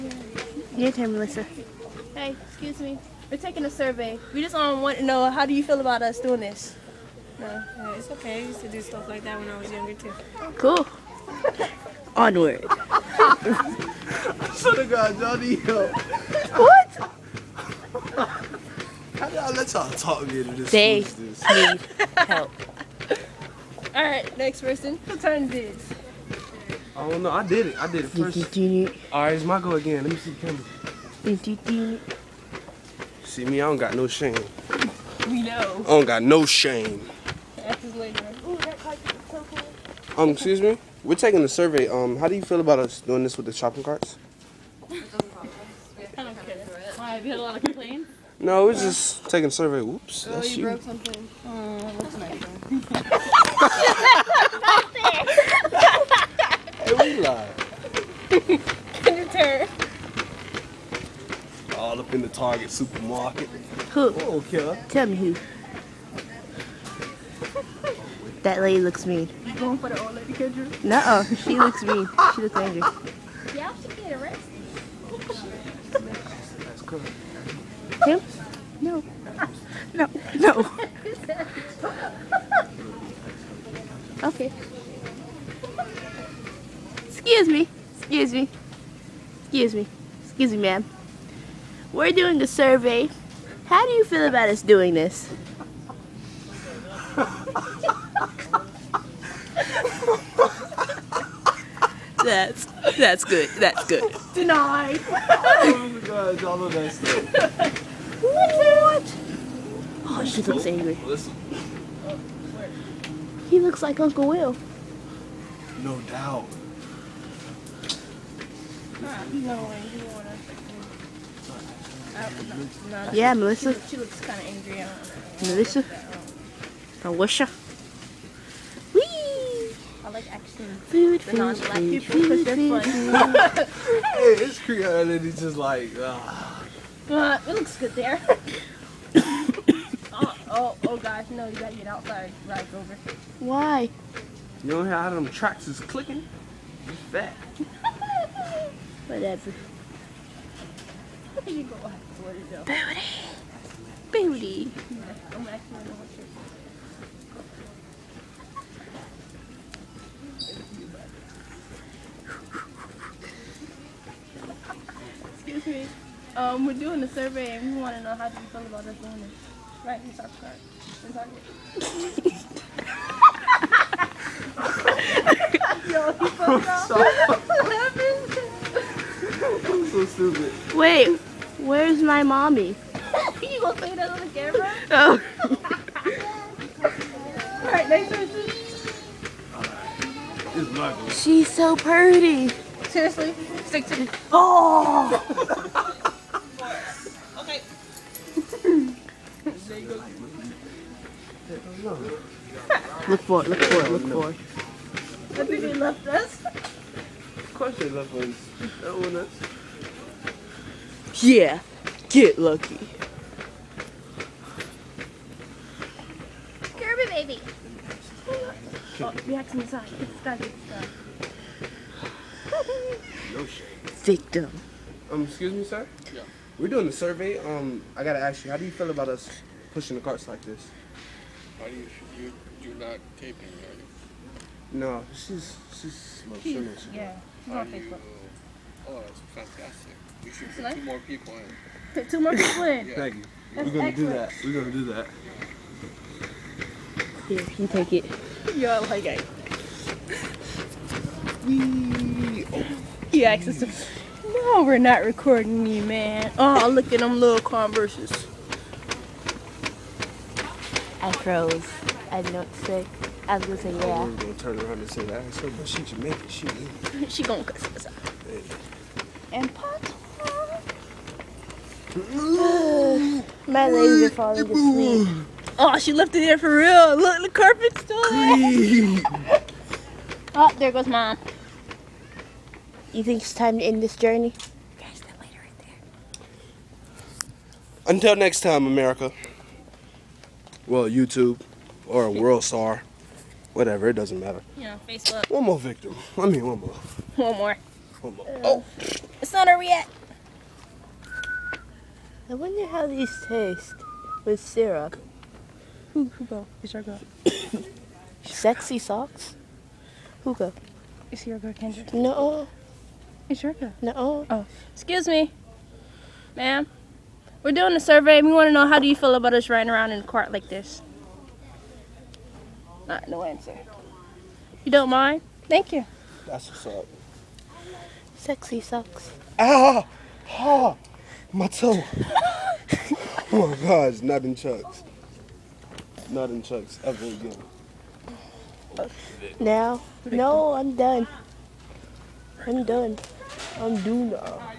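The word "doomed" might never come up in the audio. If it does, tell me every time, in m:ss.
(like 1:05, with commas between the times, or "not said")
5:43.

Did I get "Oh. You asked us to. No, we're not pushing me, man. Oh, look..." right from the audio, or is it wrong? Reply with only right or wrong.
wrong.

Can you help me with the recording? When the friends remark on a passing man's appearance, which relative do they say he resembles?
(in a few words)
Uncle Will.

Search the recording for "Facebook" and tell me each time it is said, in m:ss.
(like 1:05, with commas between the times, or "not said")
3:57, 4:54.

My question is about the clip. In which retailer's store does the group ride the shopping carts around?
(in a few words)
Target.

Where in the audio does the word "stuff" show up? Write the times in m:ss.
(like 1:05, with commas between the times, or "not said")
0:08, 1:46.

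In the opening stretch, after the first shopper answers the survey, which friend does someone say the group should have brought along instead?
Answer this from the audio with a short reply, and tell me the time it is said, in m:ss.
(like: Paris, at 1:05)
Johnny, at 0:15.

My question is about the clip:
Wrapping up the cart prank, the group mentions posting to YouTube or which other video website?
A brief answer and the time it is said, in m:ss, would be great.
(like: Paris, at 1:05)
World Star, at 4:52.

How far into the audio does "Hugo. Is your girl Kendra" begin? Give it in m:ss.
5:10.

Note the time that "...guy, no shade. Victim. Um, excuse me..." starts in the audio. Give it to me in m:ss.
3:40.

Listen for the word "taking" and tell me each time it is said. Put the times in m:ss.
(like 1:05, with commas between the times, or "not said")
0:03, 0:41, 0:49.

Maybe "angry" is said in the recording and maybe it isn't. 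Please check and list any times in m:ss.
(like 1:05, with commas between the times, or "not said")
1:12, 1:50, 2:04.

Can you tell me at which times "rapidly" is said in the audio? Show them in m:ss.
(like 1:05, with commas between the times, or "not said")
not said.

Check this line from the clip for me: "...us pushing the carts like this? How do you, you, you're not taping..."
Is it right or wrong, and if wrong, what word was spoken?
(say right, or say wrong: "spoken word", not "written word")
right.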